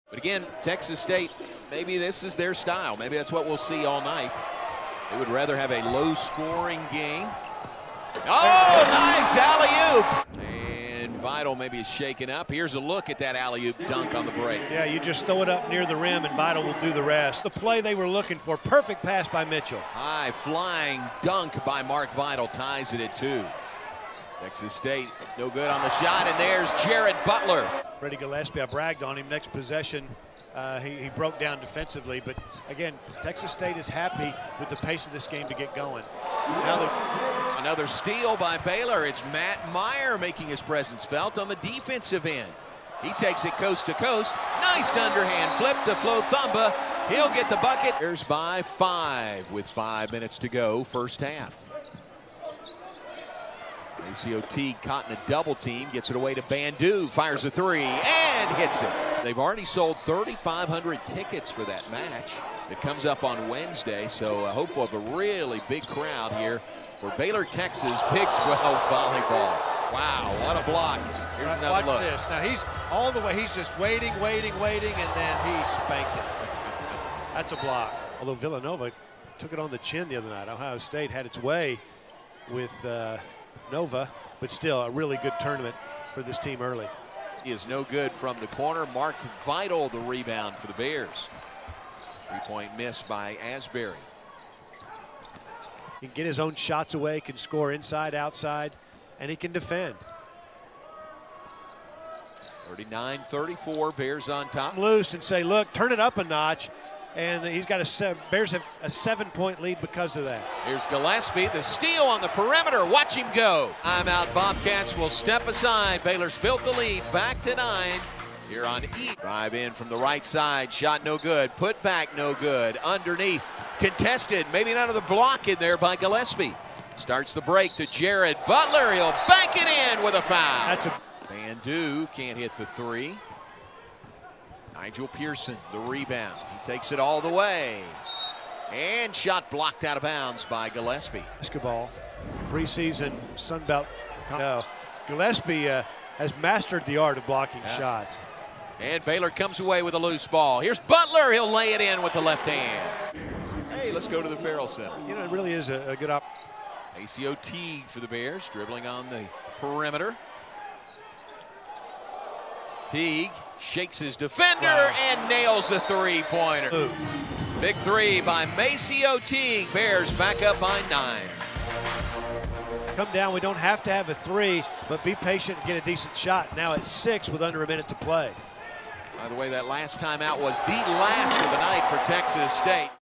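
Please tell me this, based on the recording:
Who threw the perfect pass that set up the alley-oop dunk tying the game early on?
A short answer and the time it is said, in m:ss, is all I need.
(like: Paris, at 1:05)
Mitchell, at 0:19.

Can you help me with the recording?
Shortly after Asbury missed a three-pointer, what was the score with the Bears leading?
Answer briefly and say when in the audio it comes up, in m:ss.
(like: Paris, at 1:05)
39-34, at 1:42.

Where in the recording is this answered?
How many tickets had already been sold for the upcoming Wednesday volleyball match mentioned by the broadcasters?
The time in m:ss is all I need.
1:00.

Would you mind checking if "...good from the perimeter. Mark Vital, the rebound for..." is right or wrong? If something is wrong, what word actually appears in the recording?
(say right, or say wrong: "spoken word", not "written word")
wrong: "corner", not "perimeter".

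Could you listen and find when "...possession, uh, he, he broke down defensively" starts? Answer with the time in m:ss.
0:29.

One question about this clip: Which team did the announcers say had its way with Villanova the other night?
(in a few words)
Ohio State.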